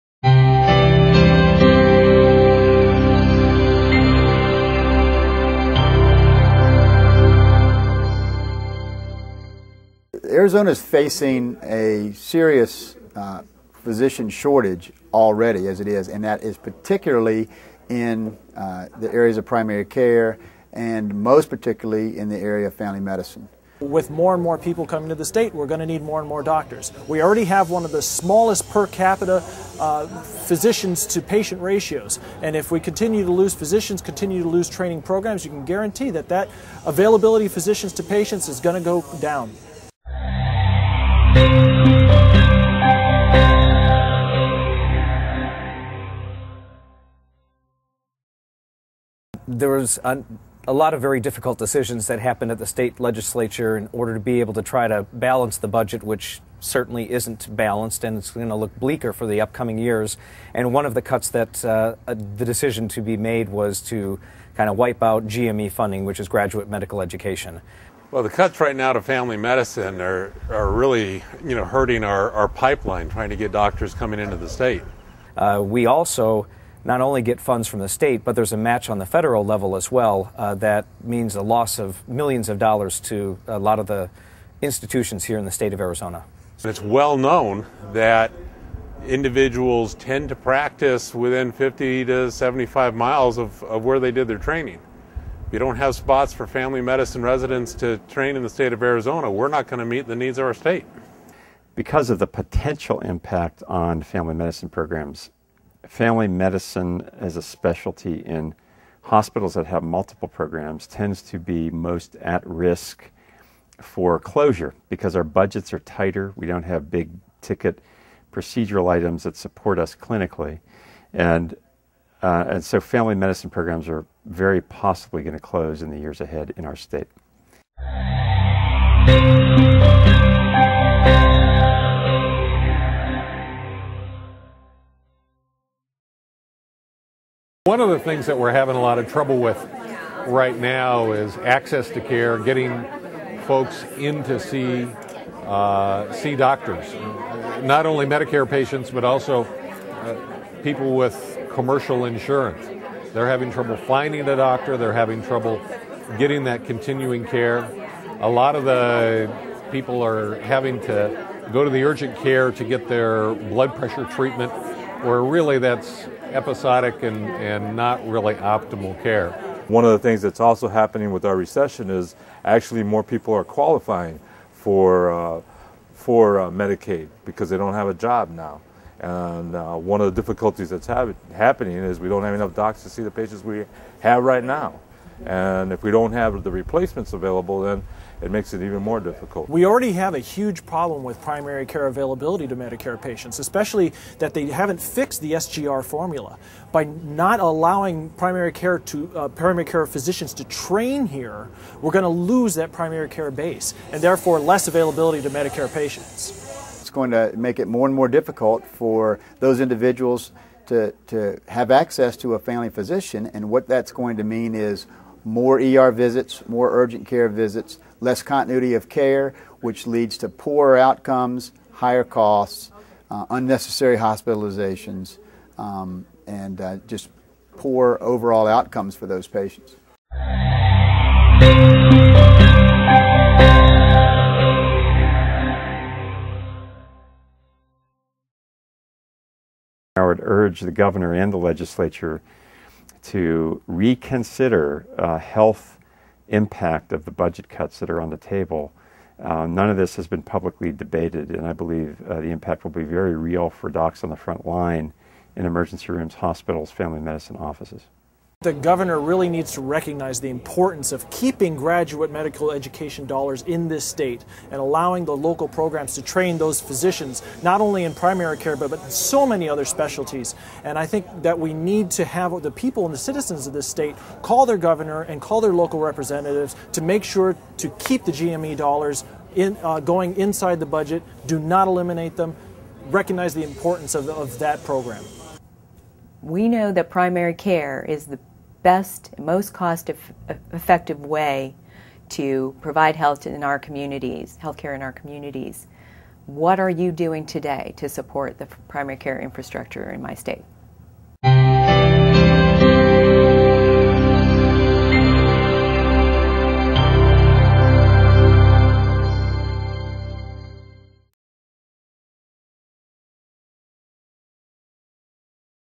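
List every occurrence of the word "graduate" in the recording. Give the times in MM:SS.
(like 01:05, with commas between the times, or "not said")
01:06, 04:21.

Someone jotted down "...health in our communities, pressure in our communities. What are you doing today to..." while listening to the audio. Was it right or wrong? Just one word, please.
wrong.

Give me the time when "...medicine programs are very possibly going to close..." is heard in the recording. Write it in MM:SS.
02:03.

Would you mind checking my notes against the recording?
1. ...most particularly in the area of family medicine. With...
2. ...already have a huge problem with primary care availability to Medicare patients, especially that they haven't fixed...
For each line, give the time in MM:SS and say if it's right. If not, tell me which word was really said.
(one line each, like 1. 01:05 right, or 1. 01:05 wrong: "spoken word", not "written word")
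1. 00:21 right
2. 03:09 right.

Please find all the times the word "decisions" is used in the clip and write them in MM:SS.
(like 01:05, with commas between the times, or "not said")
00:51, 01:02.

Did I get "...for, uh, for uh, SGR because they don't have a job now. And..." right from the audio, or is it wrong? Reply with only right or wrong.
wrong.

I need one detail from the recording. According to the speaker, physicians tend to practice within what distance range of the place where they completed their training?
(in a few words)
50 to 75 miles.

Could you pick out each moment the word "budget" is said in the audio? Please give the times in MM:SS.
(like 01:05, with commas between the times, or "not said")
00:55, 01:55, 04:07, 04:40.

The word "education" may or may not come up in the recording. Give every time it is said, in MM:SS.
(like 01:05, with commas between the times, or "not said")
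01:07, 04:22.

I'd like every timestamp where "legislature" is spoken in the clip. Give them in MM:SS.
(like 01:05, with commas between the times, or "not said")
00:52, 04:01.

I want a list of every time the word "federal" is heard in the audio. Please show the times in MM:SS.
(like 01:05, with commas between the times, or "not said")
01:19.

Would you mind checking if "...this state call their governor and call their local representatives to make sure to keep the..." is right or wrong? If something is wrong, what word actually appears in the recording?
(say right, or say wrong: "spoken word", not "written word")
right.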